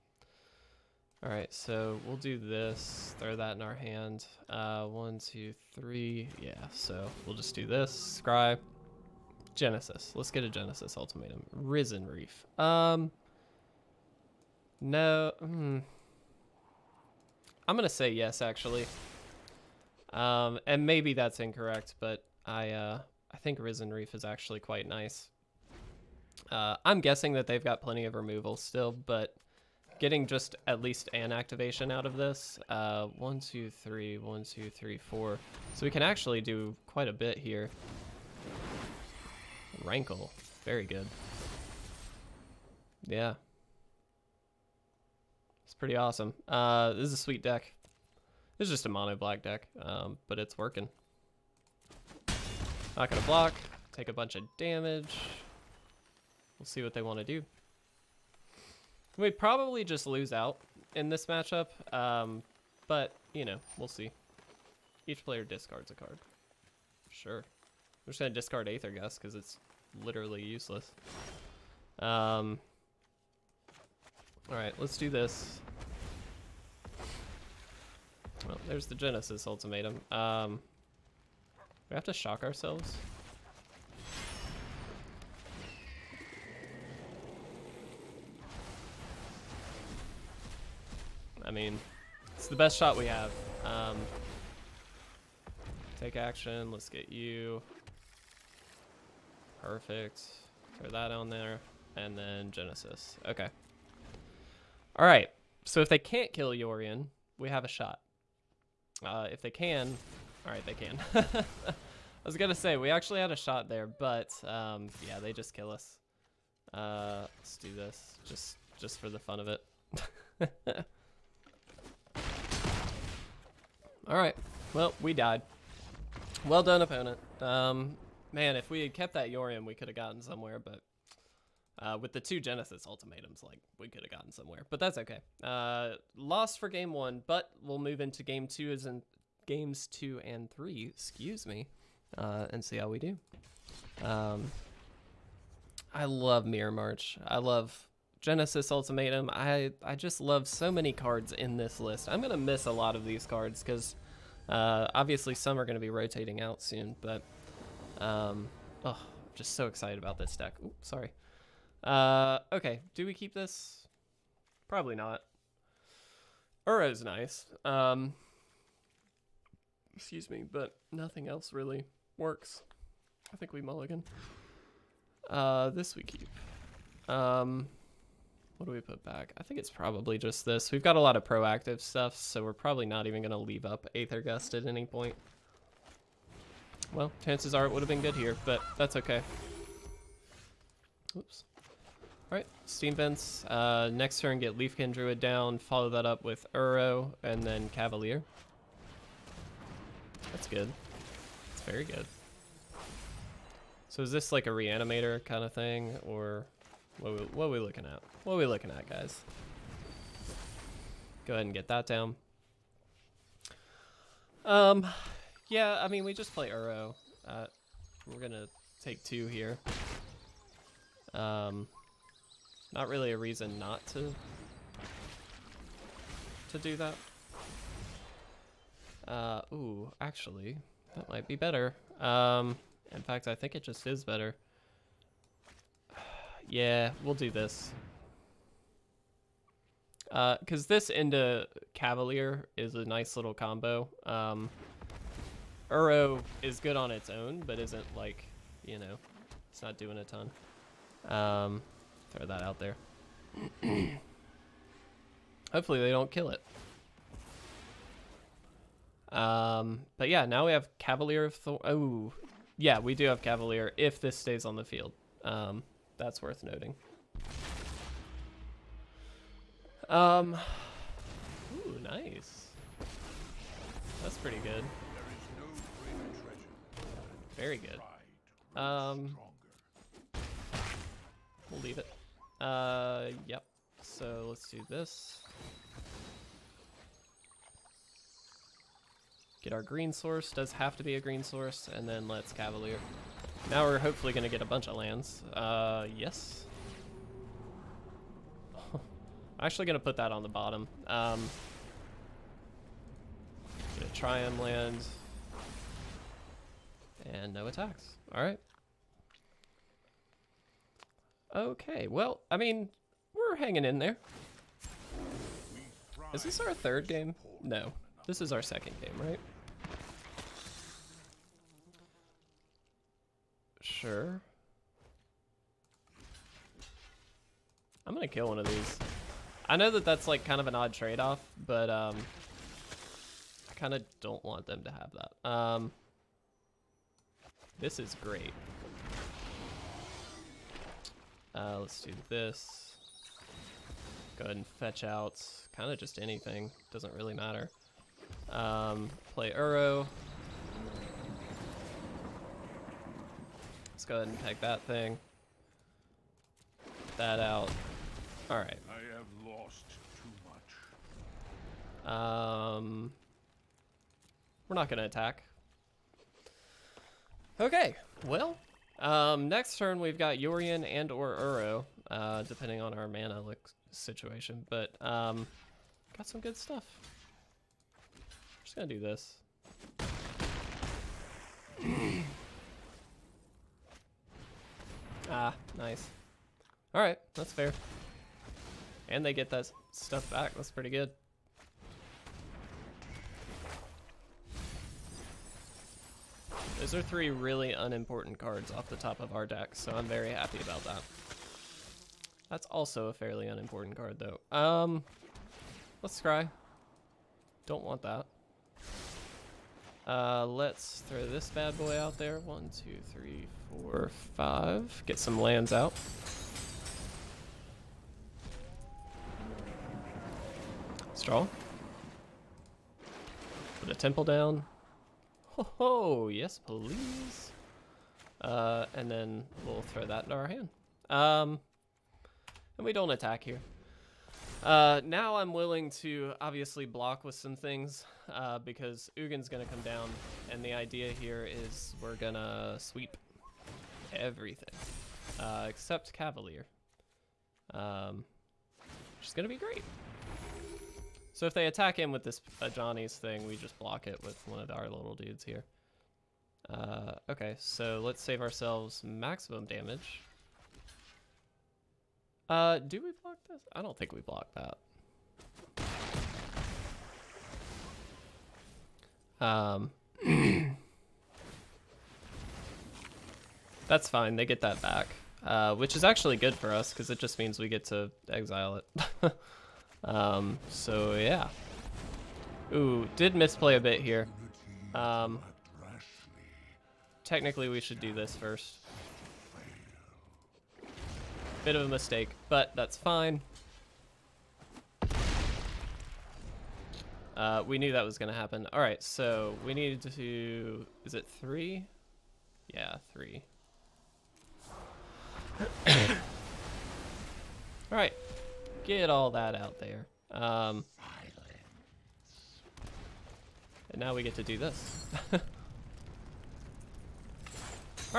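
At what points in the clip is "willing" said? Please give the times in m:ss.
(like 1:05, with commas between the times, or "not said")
7:15.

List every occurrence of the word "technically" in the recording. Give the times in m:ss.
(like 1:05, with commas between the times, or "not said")
8:07.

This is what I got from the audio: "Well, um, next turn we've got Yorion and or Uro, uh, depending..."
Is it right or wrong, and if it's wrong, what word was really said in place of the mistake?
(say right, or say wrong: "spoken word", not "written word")
right.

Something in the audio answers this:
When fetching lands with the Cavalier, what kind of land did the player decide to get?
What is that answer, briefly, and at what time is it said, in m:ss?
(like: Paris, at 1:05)
Triome, at 5:03.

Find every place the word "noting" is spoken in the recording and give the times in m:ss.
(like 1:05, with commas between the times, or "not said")
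4:26.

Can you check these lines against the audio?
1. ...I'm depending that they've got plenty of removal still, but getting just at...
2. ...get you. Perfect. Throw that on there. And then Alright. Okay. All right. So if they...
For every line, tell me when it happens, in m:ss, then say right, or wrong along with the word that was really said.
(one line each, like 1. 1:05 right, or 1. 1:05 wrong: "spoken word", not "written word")
1. 0:26 wrong: "guessing", not "depending"
2. 1:36 wrong: "Genesis", not "Alright".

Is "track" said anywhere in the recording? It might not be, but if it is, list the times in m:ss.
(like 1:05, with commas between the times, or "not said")
not said.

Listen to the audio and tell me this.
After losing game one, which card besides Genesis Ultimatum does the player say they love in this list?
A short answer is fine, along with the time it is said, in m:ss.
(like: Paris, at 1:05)
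Mirror March, at 2:26.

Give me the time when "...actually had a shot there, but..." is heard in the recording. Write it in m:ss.
1:52.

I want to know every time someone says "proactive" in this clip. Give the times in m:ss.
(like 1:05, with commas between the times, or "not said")
3:01.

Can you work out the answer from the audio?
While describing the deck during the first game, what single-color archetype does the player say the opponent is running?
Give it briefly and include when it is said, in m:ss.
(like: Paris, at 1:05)
mono black, at 0:48.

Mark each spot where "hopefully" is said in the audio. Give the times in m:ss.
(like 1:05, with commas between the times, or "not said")
4:15, 4:53.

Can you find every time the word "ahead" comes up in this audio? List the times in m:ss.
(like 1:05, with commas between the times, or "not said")
3:31, 5:44, 5:53.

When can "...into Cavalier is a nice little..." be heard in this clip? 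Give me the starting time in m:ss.
4:00.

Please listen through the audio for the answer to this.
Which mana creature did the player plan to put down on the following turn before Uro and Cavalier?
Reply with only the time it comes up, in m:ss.
3:14.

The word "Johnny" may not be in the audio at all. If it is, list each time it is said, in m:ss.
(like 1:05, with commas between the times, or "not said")
7:32.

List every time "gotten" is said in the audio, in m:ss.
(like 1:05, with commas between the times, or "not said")
2:09, 2:14.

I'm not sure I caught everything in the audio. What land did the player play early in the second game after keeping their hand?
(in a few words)
Steam Vents.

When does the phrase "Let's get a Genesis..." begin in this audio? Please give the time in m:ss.
0:10.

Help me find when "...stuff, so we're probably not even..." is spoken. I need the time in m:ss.
3:01.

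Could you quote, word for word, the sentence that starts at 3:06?
Well, chances are it would have been good here, but that's okay.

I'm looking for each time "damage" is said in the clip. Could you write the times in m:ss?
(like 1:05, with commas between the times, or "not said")
0:54, 7:39.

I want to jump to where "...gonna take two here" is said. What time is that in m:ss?
3:38.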